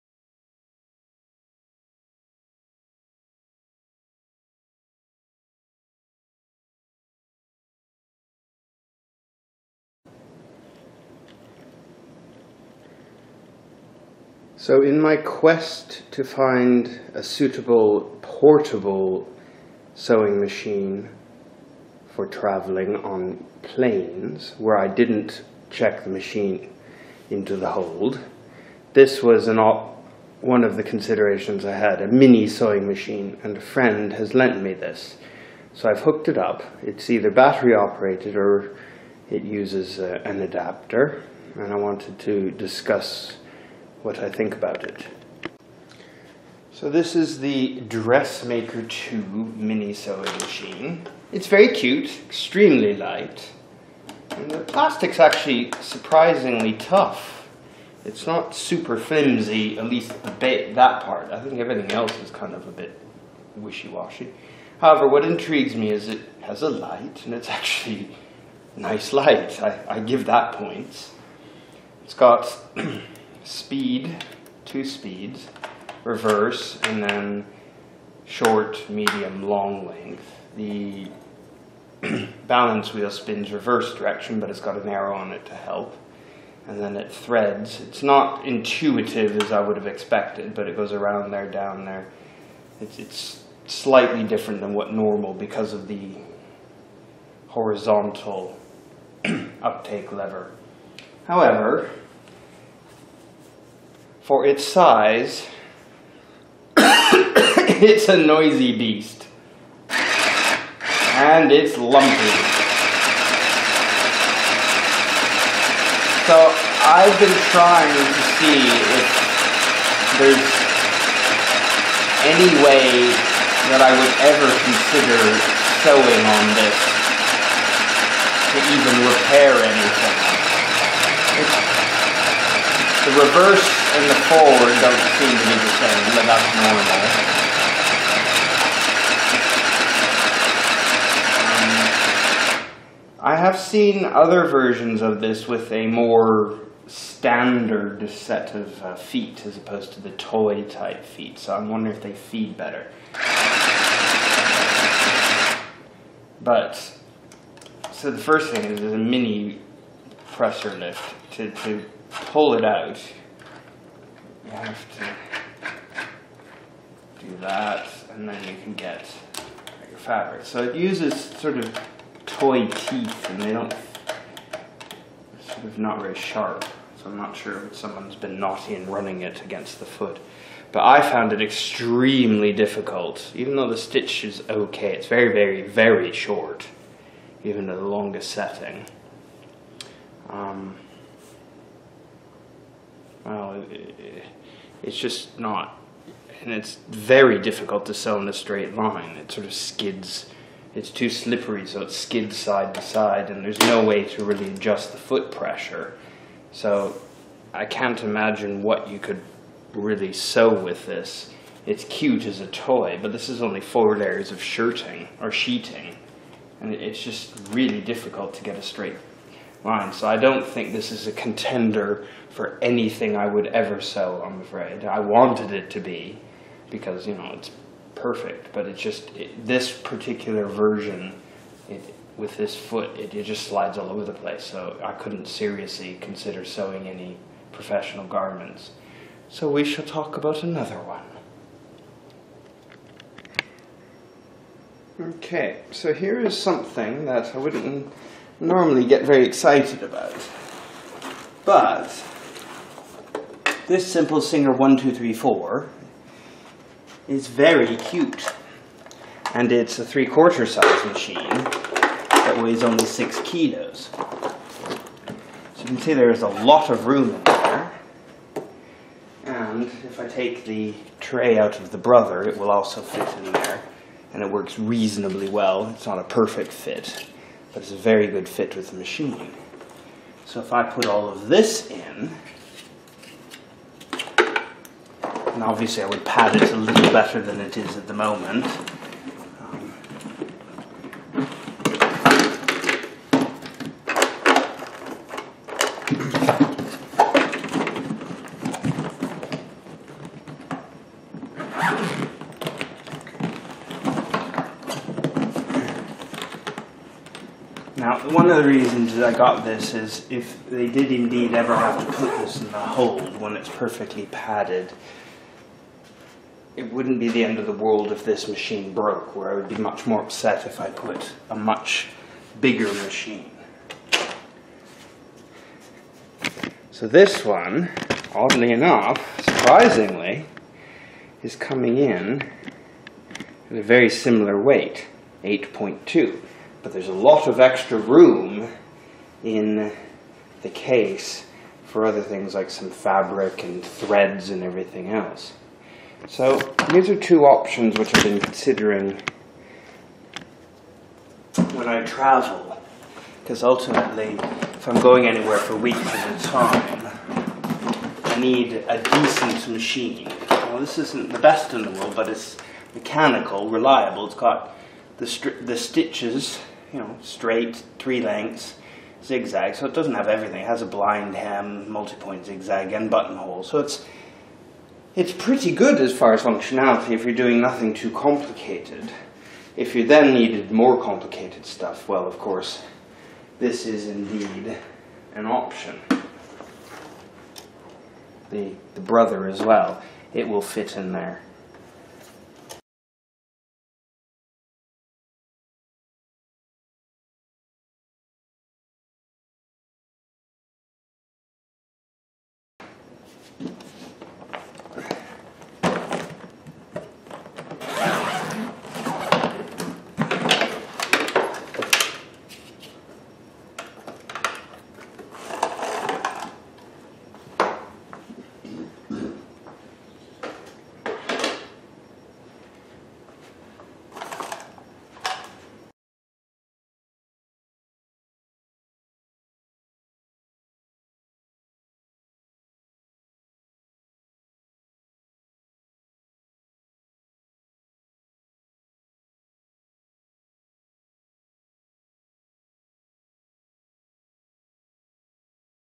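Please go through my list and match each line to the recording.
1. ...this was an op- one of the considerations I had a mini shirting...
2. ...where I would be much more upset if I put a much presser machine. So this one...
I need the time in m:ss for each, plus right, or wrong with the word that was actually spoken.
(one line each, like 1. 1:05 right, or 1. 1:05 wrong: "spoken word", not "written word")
1. 0:28 wrong: "sewing", not "shirting"
2. 5:19 wrong: "bigger", not "presser".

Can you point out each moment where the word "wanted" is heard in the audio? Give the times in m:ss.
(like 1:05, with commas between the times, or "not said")
0:41, 3:44.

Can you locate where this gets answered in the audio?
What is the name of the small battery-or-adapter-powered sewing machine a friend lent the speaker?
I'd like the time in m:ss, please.
0:47.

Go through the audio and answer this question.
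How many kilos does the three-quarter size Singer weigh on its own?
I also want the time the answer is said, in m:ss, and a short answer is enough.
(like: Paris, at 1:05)
6, at 4:22.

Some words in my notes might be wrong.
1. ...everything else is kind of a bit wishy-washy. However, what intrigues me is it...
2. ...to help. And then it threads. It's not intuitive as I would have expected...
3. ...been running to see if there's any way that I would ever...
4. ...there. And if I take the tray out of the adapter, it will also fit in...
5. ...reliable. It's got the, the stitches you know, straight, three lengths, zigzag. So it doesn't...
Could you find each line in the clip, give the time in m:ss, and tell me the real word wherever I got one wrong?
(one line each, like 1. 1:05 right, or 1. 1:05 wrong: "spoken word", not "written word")
1. 1:01 right
2. 1:25 right
3. 1:57 wrong: "trying", not "running"
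4. 4:27 wrong: "brother", not "adapter"
5. 6:03 right.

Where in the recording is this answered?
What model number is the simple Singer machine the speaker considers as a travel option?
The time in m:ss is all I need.
4:14.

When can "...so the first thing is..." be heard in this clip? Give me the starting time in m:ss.
2:37.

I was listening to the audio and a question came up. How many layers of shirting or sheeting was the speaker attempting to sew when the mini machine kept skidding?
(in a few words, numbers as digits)
4.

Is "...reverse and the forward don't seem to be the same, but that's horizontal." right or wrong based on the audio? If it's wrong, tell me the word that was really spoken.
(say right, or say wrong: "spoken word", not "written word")
wrong: "normal", not "horizontal".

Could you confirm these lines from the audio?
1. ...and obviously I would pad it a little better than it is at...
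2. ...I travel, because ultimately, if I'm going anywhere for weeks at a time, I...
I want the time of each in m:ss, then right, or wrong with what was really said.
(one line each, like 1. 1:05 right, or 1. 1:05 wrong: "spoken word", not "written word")
1. 4:45 right
2. 5:51 right.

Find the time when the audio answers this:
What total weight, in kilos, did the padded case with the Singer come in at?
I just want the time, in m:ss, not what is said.
5:35.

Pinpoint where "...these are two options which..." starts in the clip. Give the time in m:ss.
5:46.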